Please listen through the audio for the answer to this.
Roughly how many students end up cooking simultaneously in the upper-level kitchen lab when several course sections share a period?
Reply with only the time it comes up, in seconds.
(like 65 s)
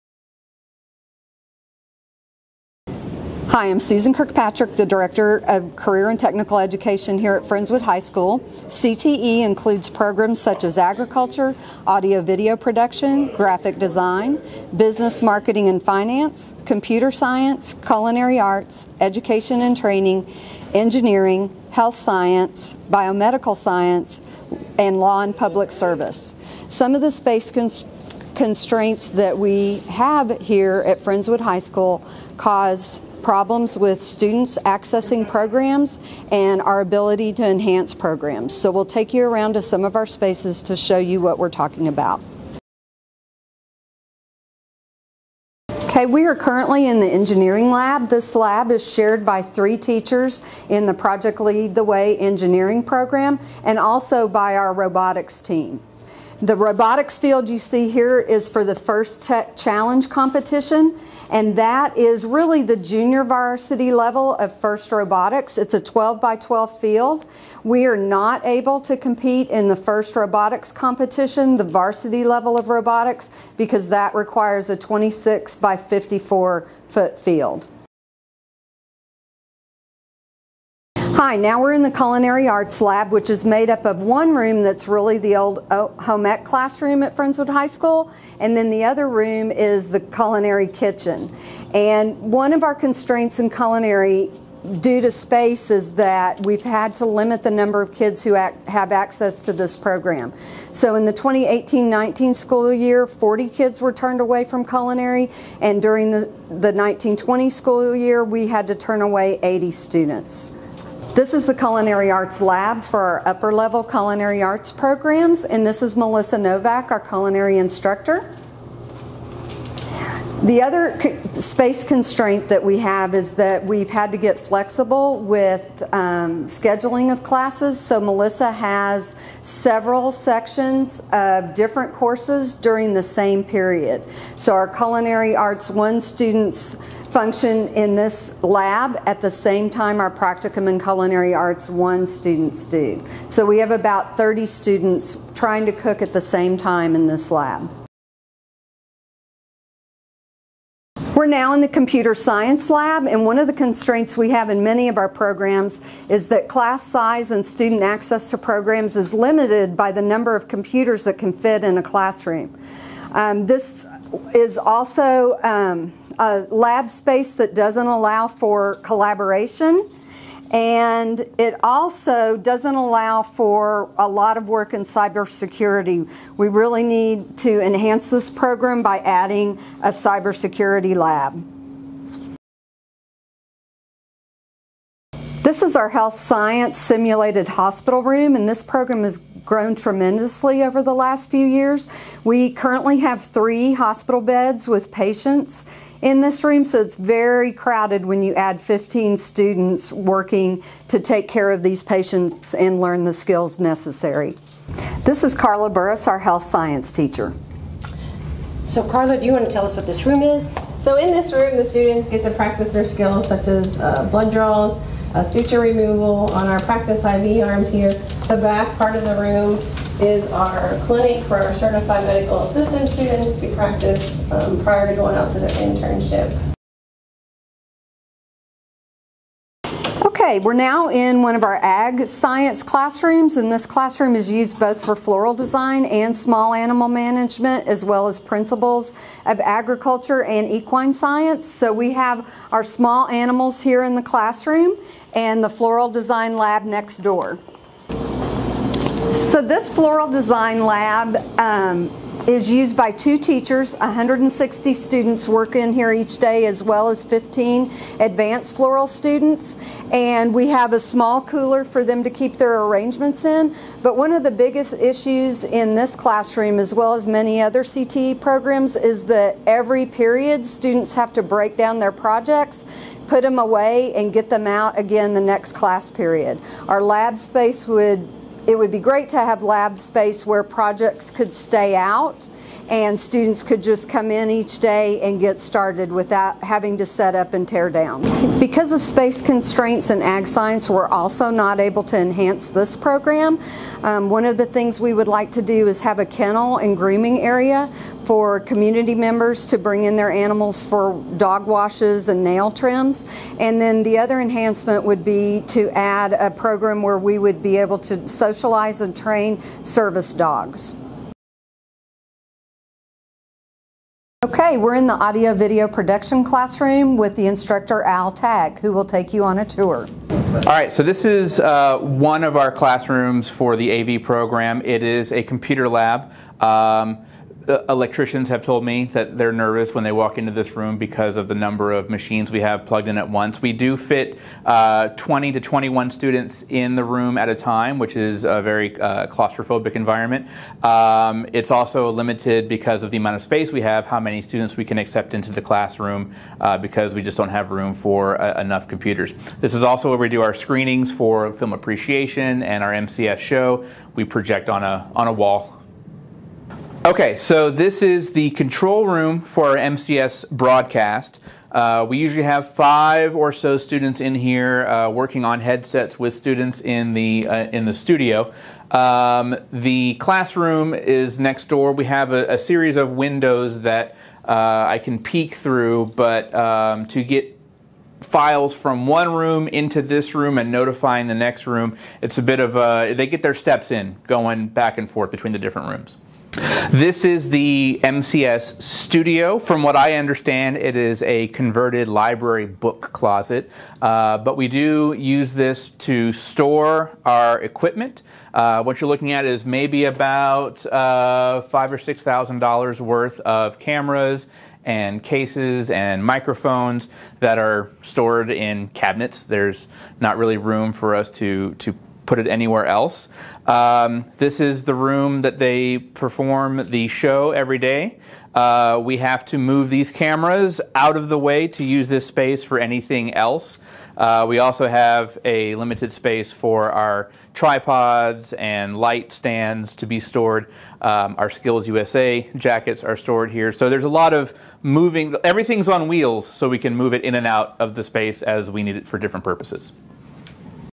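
144 s.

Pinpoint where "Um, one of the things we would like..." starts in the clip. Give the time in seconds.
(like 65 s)
293 s.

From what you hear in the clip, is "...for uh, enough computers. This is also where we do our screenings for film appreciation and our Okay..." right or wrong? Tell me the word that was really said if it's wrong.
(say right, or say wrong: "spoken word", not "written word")
wrong: "MCS", not "Okay".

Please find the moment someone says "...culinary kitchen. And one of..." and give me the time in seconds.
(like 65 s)
89 s.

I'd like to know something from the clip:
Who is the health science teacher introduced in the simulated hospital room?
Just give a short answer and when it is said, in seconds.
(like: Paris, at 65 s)
Carla Burris, at 205 s.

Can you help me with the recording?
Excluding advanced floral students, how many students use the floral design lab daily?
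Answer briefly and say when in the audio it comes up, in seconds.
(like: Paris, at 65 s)
160, at 253 s.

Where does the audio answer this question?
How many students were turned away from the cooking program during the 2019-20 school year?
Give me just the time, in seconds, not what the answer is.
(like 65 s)
109 s.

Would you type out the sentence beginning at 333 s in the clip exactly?
We do fit uh, 20 to 21 students in the room at a time, which is a very uh, claustrophobic environment.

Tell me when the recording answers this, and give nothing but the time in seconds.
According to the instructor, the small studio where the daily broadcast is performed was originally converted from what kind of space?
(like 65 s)
391 s.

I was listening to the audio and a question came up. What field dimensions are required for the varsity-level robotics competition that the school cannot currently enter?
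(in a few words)
26 by 54 foot.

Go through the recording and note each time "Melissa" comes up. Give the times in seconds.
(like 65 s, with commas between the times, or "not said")
115 s, 127 s.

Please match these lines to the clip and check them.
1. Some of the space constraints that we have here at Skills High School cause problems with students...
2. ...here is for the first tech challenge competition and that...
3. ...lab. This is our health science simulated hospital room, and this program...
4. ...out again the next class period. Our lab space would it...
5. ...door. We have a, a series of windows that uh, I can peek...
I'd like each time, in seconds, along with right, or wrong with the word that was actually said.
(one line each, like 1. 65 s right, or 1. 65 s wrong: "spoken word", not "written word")
1. 26 s wrong: "Friendswood", not "Skills"
2. 57 s right
3. 180 s right
4. 274 s right
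5. 371 s right.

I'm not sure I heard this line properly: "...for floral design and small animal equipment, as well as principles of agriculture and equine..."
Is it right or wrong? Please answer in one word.
wrong.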